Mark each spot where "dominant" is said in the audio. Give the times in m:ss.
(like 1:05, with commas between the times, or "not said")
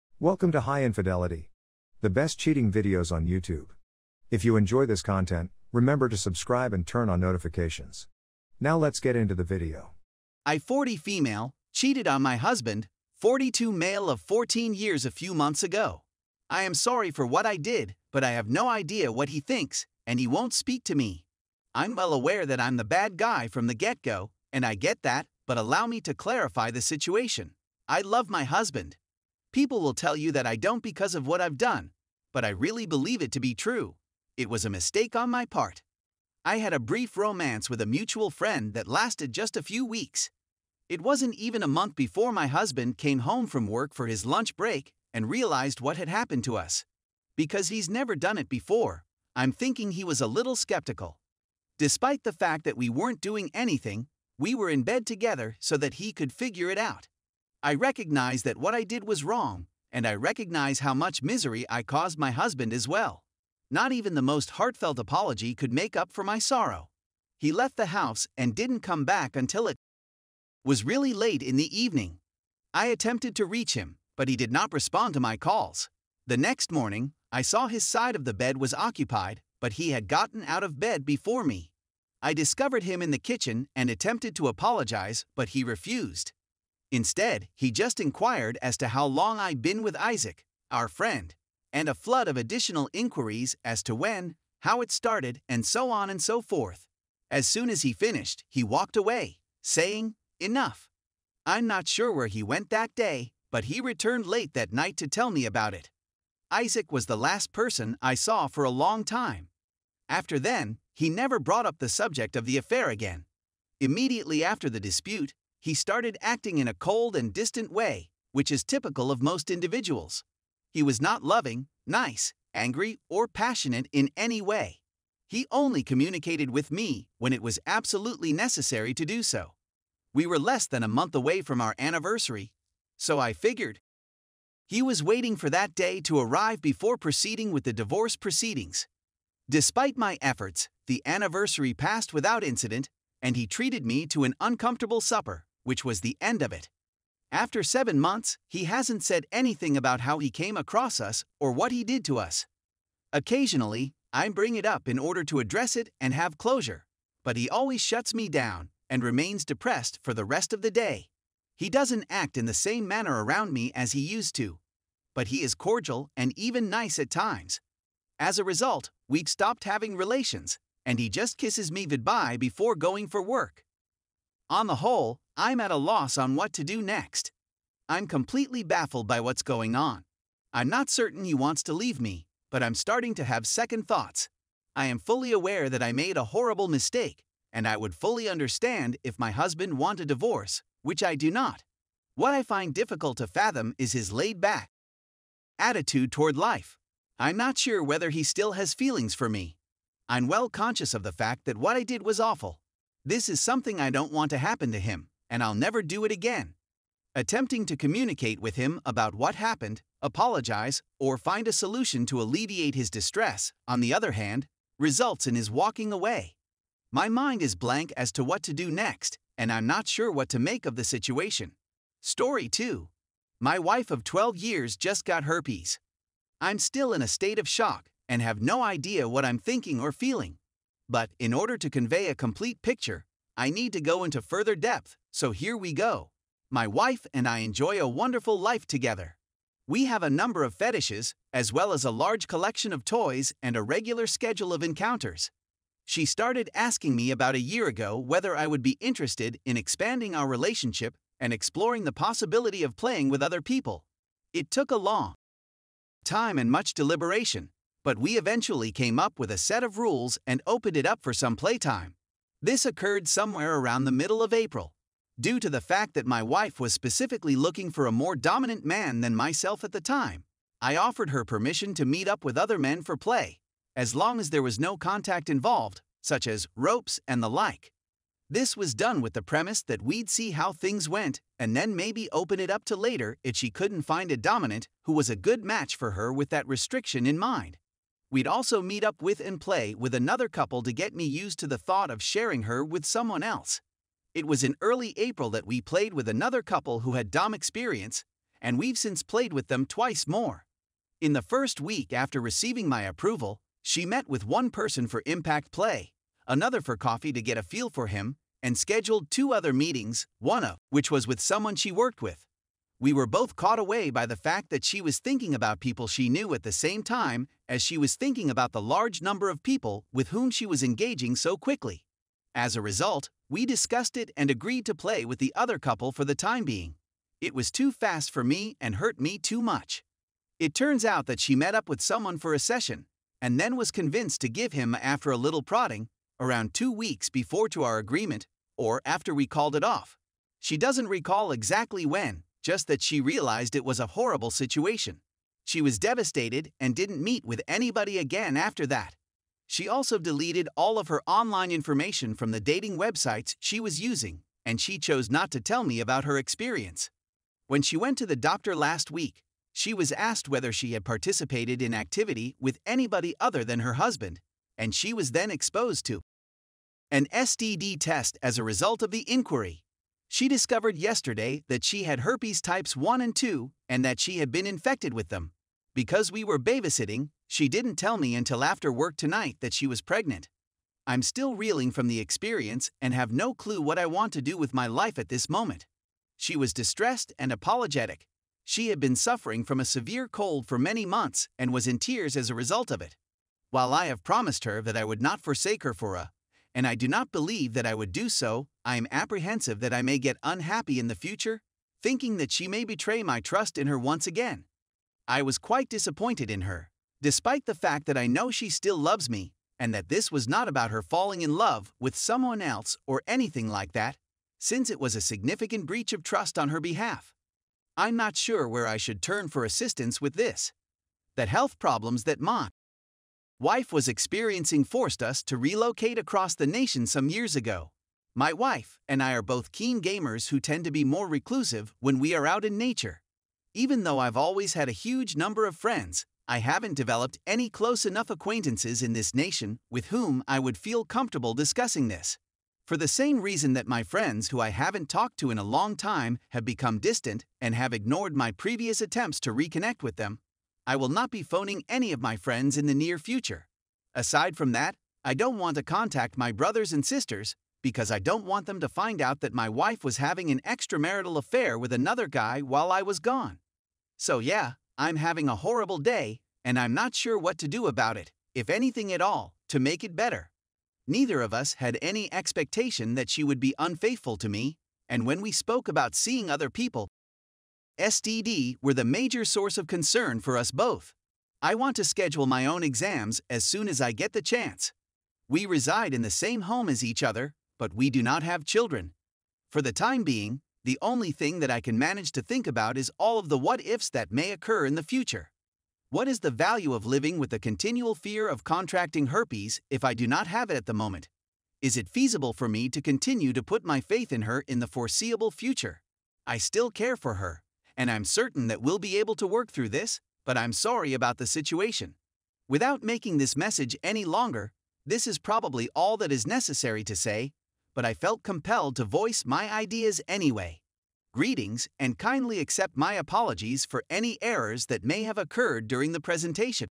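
4:28, 4:44.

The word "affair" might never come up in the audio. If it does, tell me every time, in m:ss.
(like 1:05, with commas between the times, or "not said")
1:52, 7:41.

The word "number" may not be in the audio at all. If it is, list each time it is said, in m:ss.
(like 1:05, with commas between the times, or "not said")
4:00, 5:19, 7:15.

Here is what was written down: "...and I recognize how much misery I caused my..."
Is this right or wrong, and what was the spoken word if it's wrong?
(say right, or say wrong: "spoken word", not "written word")
right.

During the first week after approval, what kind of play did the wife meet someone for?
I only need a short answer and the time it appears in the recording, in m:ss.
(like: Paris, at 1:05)
impact play, at 5:05.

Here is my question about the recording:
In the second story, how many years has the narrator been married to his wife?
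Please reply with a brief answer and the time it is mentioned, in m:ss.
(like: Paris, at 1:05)
12, at 3:44.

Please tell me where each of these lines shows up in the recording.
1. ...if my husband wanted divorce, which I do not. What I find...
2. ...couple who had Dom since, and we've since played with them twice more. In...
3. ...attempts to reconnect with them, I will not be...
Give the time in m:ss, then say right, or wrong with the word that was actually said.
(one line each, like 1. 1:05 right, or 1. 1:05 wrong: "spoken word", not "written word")
1. 3:09 right
2. 4:56 wrong: "experience", not "since"
3. 7:28 right.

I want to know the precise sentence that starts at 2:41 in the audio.
He doesn't act in the same manner around me as he used to, but he is cordial and even nice at times.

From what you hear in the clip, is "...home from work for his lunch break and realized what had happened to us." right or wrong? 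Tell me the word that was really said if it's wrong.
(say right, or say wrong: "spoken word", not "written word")
right.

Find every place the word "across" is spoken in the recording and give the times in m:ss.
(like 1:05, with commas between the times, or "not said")
2:30, 7:05.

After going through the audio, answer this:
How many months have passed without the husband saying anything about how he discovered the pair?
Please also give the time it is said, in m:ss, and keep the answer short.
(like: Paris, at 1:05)
7, at 2:27.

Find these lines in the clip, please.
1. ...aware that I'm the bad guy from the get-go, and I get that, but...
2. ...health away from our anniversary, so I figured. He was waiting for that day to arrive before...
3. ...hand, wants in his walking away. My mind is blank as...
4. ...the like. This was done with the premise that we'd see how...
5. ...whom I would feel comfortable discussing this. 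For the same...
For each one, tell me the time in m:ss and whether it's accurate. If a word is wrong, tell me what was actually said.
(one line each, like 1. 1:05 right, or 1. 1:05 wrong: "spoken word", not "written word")
1. 0:22 right
2. 2:10 wrong: "month", not "health"
3. 3:34 wrong: "results", not "wants"
4. 4:37 right
5. 7:19 right.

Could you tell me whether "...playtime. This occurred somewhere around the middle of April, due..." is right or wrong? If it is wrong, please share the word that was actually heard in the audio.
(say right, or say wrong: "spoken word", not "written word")
right.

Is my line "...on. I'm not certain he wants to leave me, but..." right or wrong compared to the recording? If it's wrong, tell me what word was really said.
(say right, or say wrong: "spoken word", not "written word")
right.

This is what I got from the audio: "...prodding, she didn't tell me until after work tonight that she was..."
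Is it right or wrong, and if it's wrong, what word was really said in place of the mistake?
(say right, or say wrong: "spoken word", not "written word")
wrong: "babysitting", not "prodding".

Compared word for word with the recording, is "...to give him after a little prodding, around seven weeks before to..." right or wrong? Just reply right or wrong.
wrong.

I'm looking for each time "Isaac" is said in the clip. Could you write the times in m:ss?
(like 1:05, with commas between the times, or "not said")
1:29, 1:46.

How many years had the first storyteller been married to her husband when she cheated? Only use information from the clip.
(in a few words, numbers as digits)
14.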